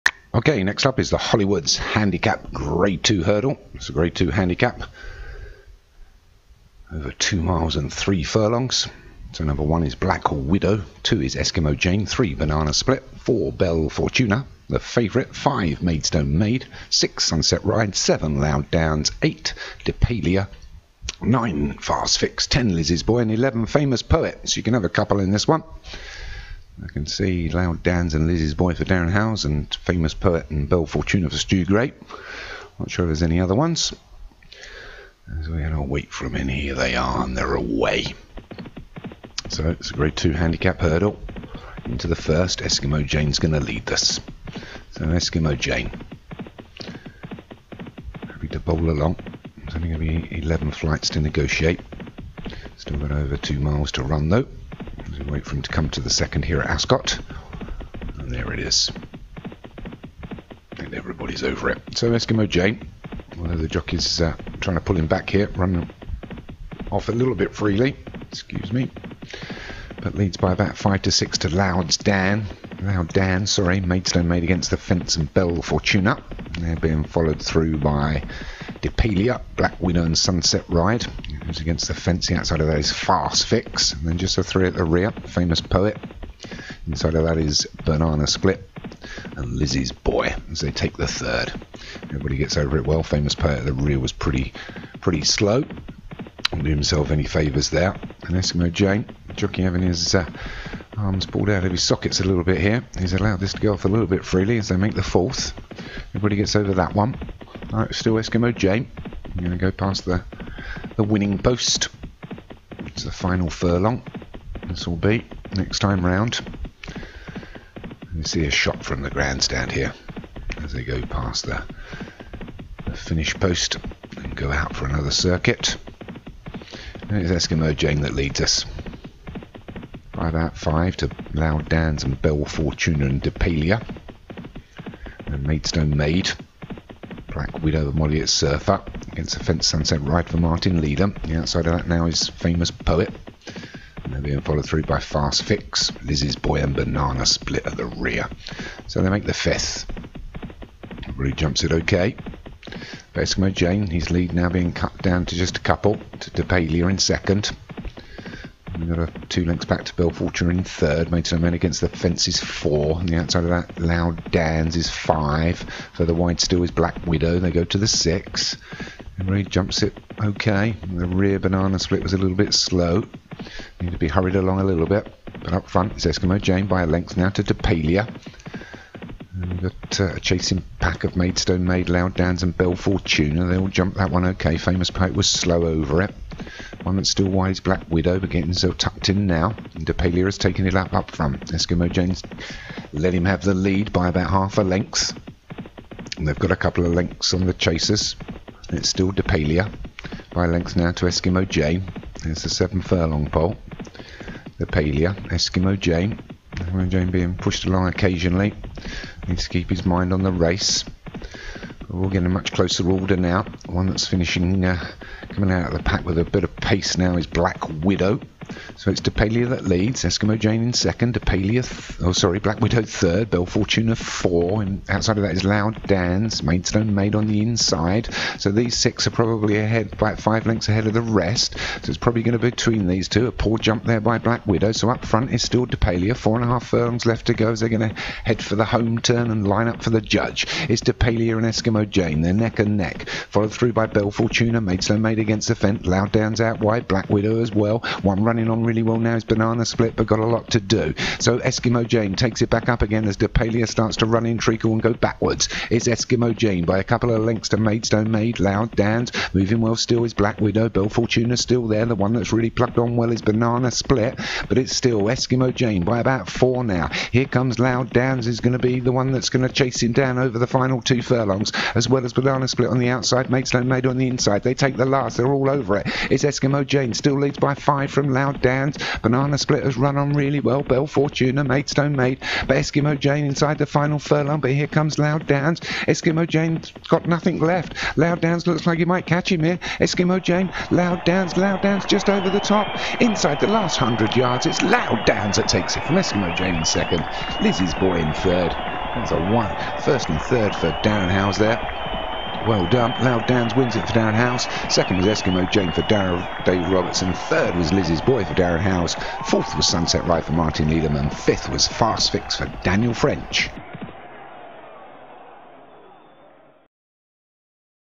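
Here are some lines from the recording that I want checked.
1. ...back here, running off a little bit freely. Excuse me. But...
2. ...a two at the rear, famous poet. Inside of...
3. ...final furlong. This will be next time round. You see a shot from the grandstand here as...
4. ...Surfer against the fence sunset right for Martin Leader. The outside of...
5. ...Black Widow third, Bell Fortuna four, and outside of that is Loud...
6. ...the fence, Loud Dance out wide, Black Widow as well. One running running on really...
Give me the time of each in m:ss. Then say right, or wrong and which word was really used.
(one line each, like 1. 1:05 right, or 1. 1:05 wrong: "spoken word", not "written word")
1. 1:05 right
2. 1:24 wrong: "three", not "two"
3. 1:53 right
4. 2:18 right
5. 3:42 right
6. 4:05 right.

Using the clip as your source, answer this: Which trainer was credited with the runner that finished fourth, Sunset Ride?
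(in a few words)
Martin Liederman.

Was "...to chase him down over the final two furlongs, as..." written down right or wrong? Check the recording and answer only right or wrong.
right.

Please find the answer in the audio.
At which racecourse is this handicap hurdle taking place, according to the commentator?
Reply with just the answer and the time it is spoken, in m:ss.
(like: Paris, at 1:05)
Ascot, at 0:56.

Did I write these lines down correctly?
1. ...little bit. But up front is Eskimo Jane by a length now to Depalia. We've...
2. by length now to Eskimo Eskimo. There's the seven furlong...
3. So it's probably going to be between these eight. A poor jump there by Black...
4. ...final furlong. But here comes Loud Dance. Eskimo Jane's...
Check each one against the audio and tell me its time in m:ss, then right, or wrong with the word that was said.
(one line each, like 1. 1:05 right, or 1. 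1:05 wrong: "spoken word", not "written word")
1. 2:54 right
2. 3:20 wrong: "Jane", not "Eskimo"
3. 3:51 wrong: "two", not "eight"
4. 4:43 right.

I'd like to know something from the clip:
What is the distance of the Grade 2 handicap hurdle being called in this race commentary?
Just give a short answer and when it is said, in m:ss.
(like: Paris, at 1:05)
Two miles and three furlongs, at 0:07.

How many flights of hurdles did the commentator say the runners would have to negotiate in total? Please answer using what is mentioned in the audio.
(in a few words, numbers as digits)
11.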